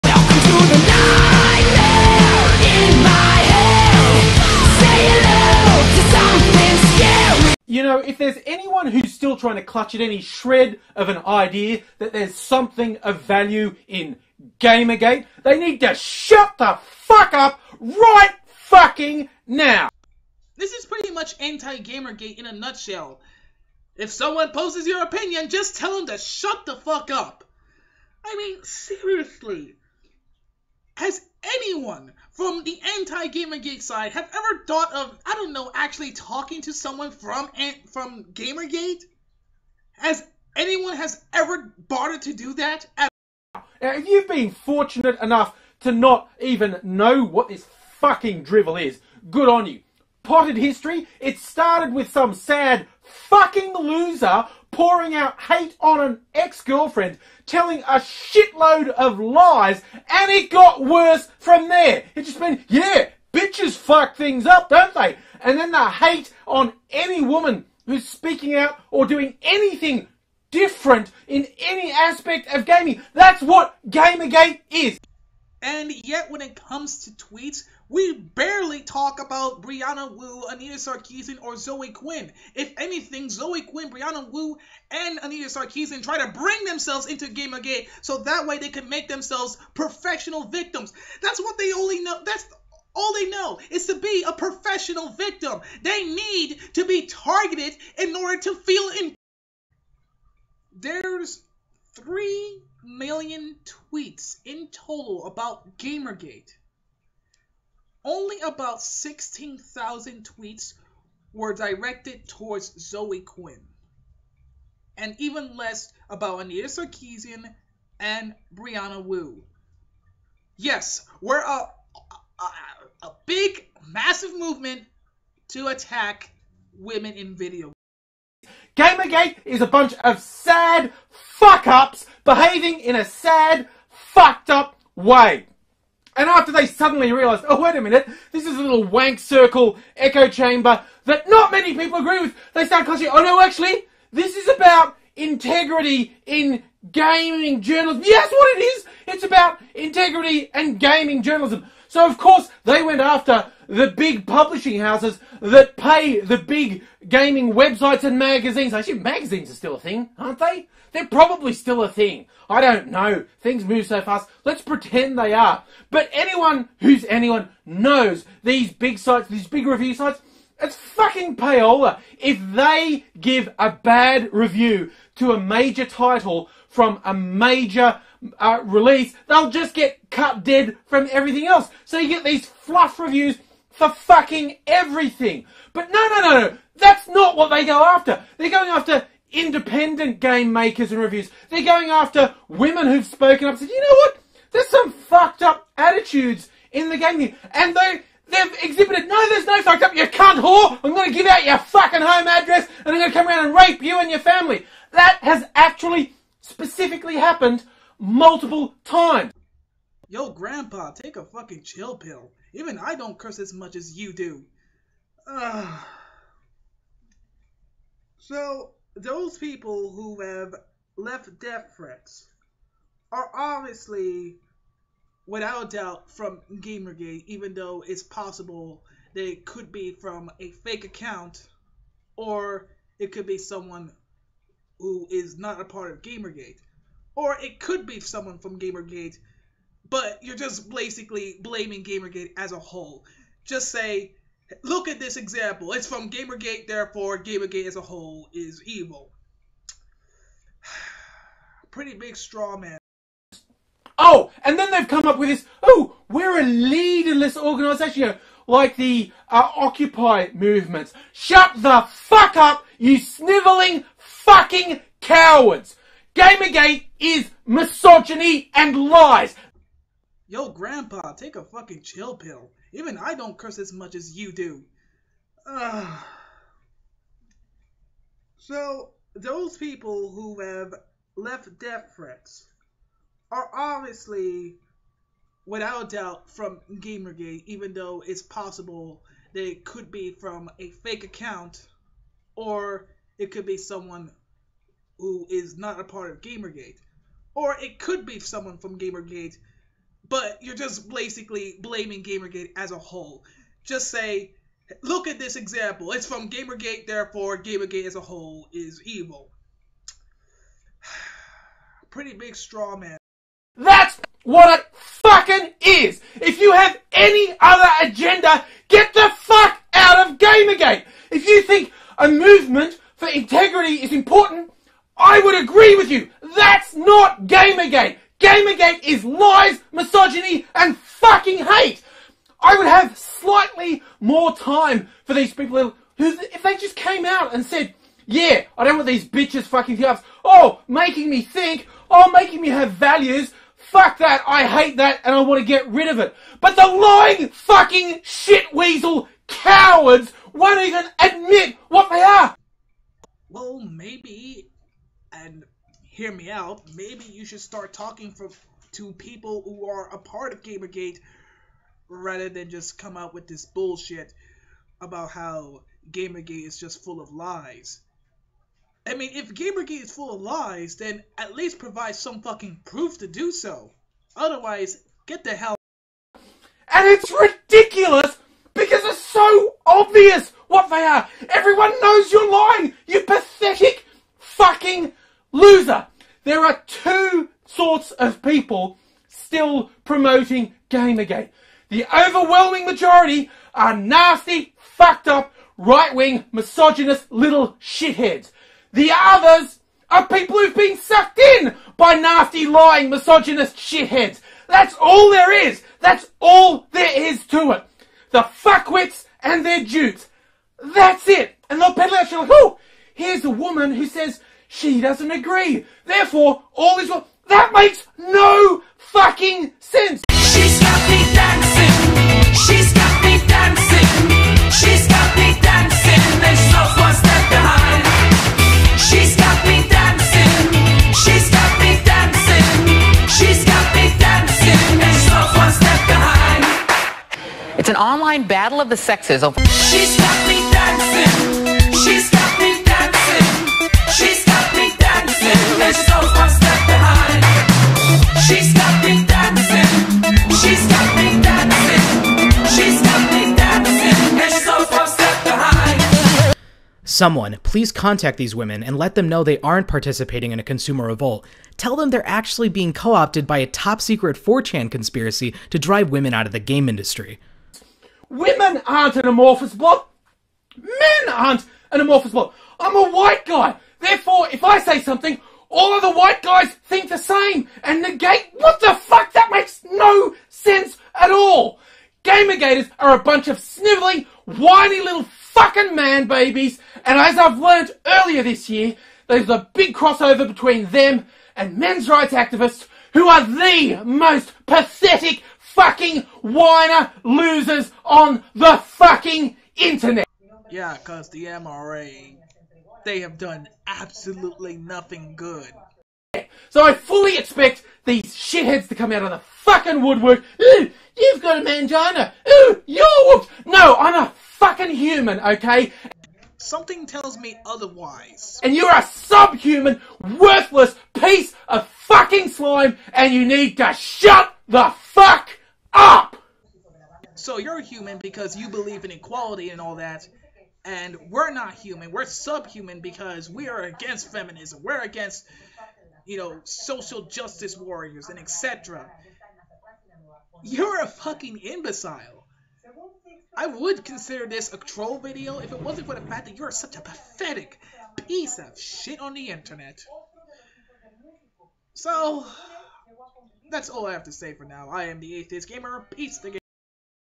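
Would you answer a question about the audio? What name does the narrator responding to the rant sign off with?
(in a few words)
The Atheist Gamer.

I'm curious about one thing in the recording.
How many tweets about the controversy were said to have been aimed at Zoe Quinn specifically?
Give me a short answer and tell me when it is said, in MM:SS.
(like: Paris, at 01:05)
16,000, at 01:48.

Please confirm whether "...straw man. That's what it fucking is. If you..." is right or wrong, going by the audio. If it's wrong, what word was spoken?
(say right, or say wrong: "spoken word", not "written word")
right.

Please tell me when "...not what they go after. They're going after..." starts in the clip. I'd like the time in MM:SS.
03:07.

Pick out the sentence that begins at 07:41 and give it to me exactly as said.
Tell them they're actually being co opted by a top secret 4chan conspiracy to drive women out of the game industry.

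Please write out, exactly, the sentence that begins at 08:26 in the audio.
So I fully expect these shitheads to come out of the fucking woodwork.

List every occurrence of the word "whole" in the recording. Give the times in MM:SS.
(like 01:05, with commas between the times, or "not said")
04:02, 04:07, 05:02, 05:08.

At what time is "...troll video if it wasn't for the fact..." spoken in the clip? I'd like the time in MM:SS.
09:04.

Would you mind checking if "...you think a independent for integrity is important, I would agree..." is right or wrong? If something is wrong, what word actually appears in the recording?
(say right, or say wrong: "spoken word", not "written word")
wrong: "movement", not "independent".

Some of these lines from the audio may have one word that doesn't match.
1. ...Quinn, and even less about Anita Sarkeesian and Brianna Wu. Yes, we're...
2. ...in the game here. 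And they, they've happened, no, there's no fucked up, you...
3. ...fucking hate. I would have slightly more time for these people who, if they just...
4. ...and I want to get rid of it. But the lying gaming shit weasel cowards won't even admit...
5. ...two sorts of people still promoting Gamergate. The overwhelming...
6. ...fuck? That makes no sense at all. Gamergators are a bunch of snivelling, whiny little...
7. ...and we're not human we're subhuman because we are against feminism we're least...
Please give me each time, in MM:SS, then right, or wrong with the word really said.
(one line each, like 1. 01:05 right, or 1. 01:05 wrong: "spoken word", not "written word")
1. 01:53 right
2. 03:16 wrong: "exhibited", not "happened"
3. 05:30 right
4. 05:45 wrong: "fucking", not "gaming"
5. 06:26 right
6. 07:58 right
7. 08:50 wrong: "against", not "least".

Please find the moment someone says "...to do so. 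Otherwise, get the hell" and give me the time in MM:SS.
06:12.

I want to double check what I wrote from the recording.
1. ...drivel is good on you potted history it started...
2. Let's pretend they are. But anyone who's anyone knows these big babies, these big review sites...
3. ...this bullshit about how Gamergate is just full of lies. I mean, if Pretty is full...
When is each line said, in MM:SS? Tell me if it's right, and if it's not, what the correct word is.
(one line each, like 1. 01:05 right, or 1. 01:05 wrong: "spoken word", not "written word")
1. 00:48 right
2. 02:44 wrong: "sites", not "babies"
3. 06:03 wrong: "Gamergate", not "Pretty".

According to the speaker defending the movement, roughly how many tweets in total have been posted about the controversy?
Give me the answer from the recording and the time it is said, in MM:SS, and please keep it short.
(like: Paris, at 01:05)
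3 million, at 01:41.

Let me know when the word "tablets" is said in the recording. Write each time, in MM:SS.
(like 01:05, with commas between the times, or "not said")
not said.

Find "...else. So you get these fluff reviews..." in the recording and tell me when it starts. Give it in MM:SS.
03:01.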